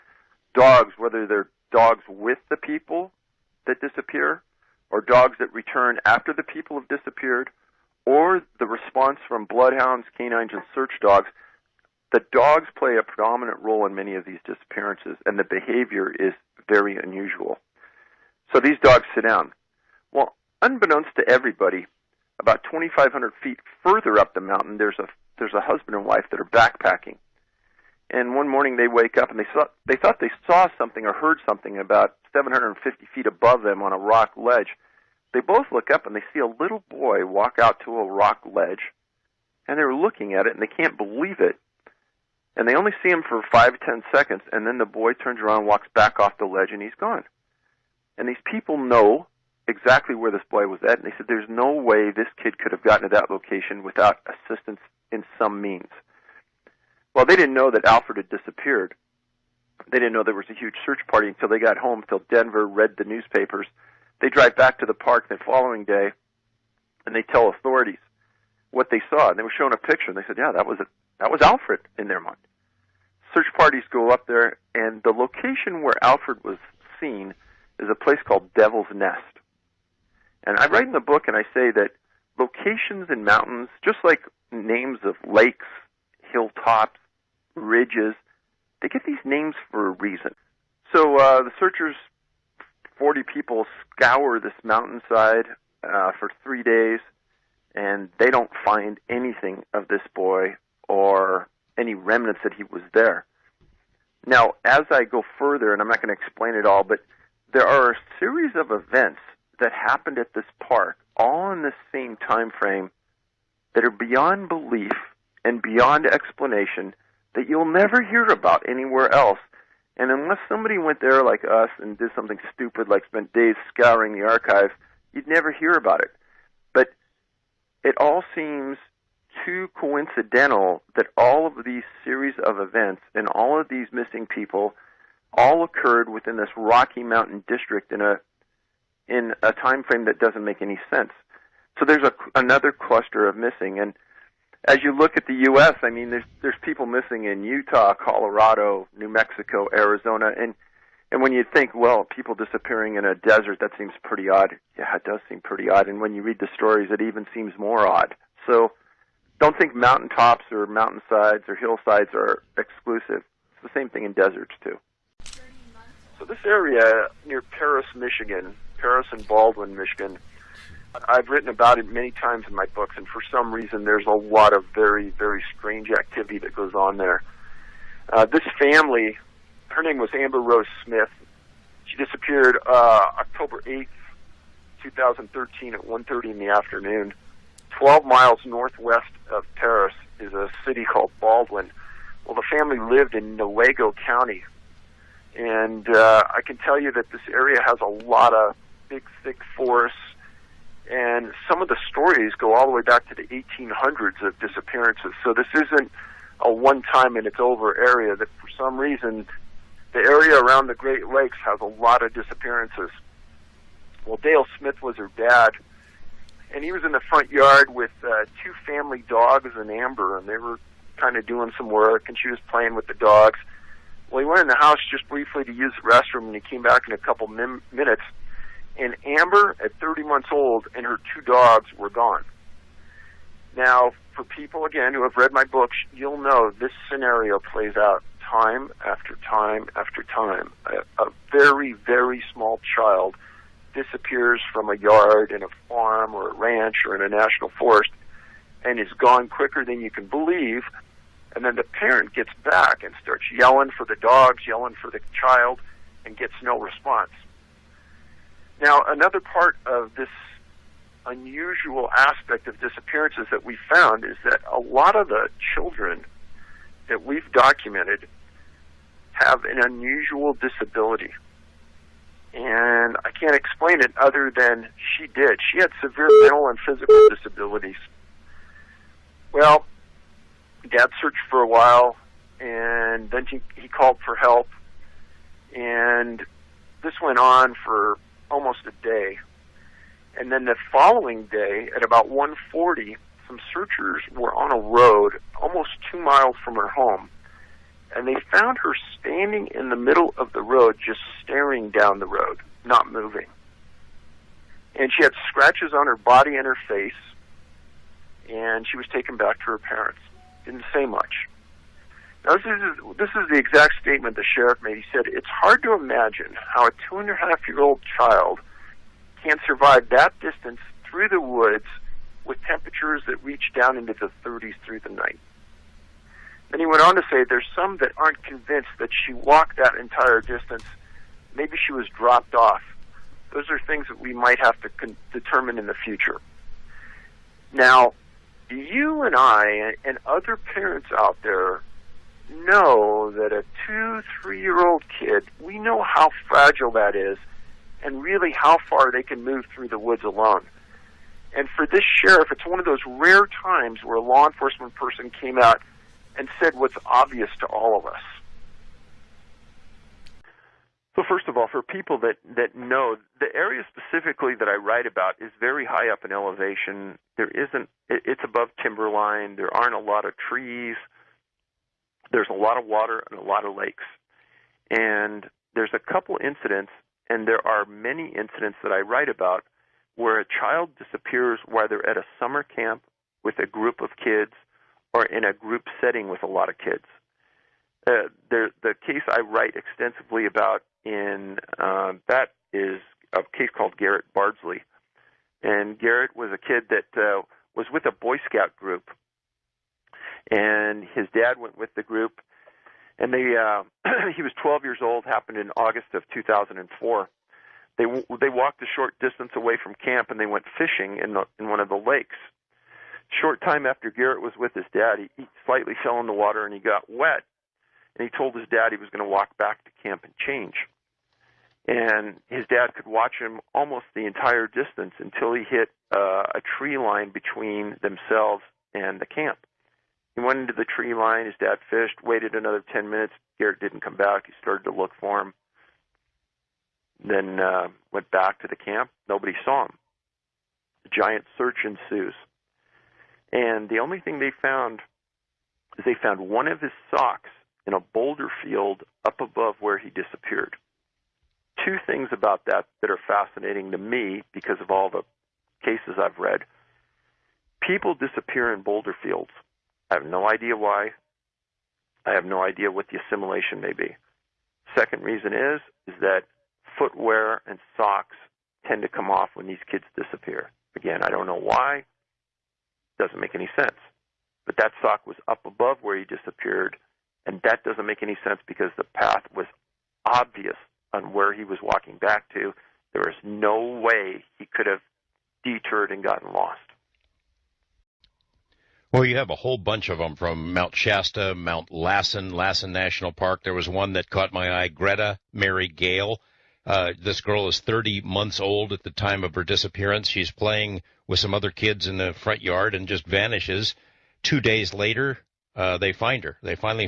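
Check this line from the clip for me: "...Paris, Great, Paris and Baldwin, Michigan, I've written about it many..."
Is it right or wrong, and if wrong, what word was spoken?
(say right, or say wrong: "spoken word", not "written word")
wrong: "Michigan", not "Great".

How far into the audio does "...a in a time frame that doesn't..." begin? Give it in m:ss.
2:18.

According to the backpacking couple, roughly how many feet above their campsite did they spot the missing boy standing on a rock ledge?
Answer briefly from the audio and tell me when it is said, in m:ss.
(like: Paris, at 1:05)
750 feet, at 0:32.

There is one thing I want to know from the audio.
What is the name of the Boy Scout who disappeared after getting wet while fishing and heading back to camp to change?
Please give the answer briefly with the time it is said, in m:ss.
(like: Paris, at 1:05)
Garrett Bardsley, at 6:33.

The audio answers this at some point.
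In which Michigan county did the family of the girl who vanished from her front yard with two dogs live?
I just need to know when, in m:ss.
3:13.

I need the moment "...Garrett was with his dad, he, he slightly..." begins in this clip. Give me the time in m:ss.
6:53.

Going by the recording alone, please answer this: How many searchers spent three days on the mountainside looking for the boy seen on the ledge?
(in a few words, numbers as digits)
40.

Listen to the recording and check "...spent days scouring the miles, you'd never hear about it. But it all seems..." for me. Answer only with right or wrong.
wrong.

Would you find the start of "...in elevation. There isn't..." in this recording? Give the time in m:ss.
6:06.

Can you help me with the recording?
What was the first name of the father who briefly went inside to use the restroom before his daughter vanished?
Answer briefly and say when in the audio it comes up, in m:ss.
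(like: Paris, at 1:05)
Dale, at 3:34.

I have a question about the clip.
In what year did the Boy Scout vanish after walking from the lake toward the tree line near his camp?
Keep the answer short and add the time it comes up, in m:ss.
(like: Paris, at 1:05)
2004, at 6:46.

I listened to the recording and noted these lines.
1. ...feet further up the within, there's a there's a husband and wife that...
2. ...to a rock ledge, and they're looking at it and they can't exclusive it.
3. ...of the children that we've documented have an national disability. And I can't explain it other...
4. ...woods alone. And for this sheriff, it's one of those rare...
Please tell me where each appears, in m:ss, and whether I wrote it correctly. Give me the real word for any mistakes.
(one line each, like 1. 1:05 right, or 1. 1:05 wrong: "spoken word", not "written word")
1. 0:23 wrong: "mountain", not "within"
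2. 0:37 wrong: "believe", not "exclusive"
3. 4:24 wrong: "unusual", not "national"
4. 5:49 right.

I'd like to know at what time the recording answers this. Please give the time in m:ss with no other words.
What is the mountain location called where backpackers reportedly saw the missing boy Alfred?
1:18.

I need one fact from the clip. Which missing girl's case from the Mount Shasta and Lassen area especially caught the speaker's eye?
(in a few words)
Greta Mary Gale.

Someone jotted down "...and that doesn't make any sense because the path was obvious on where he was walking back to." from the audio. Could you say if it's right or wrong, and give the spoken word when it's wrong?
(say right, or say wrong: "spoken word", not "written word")
right.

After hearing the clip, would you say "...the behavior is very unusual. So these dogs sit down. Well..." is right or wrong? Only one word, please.
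right.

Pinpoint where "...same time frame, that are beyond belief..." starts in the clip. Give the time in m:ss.
1:51.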